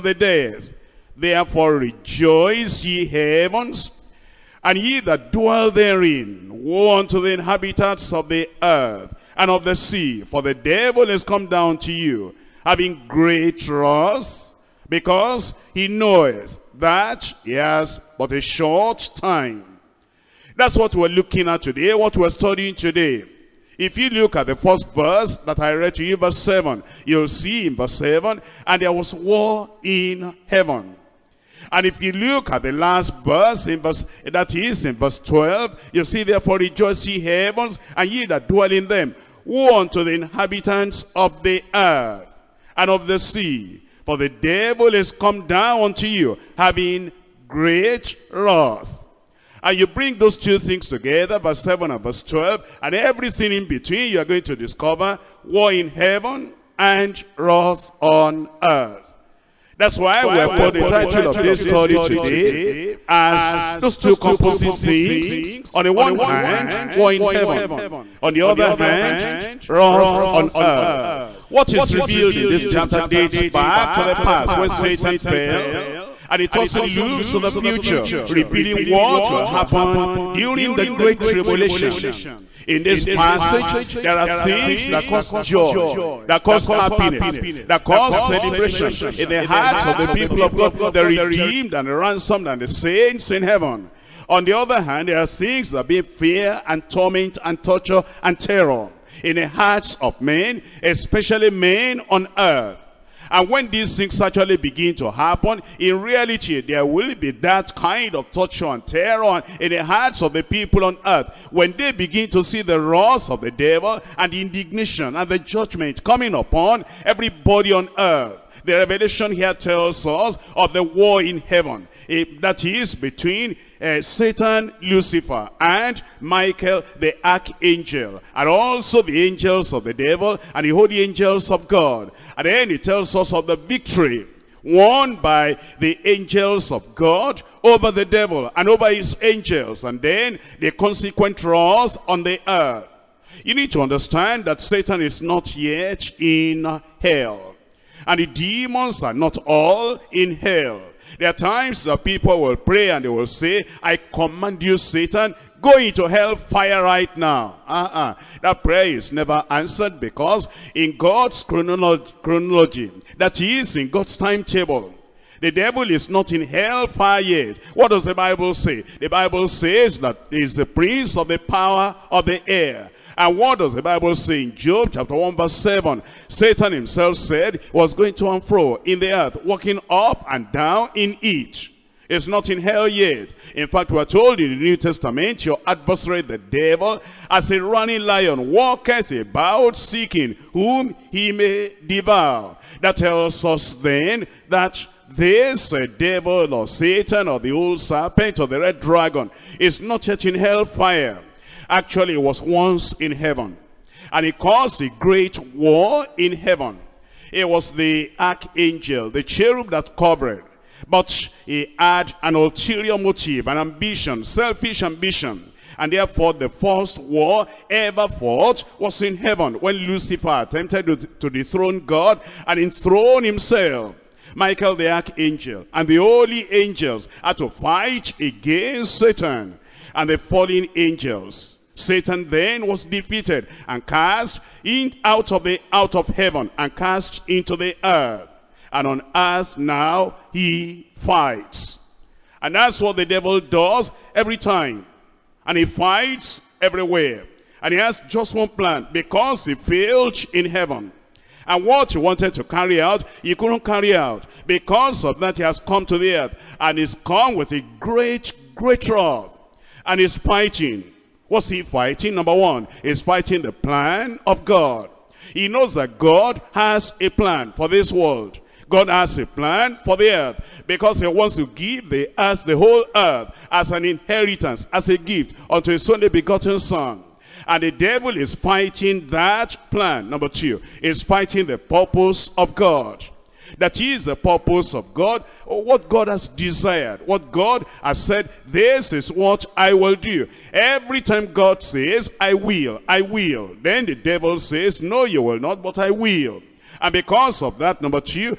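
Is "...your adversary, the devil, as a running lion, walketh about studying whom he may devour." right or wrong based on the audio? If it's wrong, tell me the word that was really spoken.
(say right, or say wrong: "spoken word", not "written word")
wrong: "seeking", not "studying".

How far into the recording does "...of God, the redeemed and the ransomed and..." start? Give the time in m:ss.
1:30.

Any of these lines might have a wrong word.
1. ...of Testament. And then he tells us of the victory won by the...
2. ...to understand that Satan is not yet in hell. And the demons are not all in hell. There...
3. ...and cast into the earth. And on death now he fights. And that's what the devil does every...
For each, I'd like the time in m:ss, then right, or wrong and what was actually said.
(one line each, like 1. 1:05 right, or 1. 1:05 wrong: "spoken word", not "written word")
1. 2:11 wrong: "God", not "Testament"
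2. 2:23 right
3. 3:56 wrong: "earth", not "death".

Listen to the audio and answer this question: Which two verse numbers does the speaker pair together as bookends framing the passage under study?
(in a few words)
7 and 12.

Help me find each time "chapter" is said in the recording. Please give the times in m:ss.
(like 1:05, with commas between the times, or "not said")
1:12, 2:54.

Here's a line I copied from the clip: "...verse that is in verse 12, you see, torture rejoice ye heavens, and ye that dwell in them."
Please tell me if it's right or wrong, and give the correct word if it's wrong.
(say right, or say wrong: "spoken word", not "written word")
wrong: "therefore", not "torture".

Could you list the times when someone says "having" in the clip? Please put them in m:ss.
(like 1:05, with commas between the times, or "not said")
0:12, 0:46.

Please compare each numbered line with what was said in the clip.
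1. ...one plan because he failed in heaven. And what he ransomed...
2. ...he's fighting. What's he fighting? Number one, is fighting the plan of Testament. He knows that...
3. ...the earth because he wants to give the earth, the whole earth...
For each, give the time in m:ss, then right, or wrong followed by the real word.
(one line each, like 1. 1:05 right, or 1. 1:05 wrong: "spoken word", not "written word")
1. 4:08 wrong: "wanted", not "ransomed"
2. 4:19 wrong: "God", not "Testament"
3. 4:29 right.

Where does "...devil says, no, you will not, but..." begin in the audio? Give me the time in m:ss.
4:53.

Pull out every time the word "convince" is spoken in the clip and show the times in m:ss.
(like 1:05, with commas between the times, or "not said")
not said.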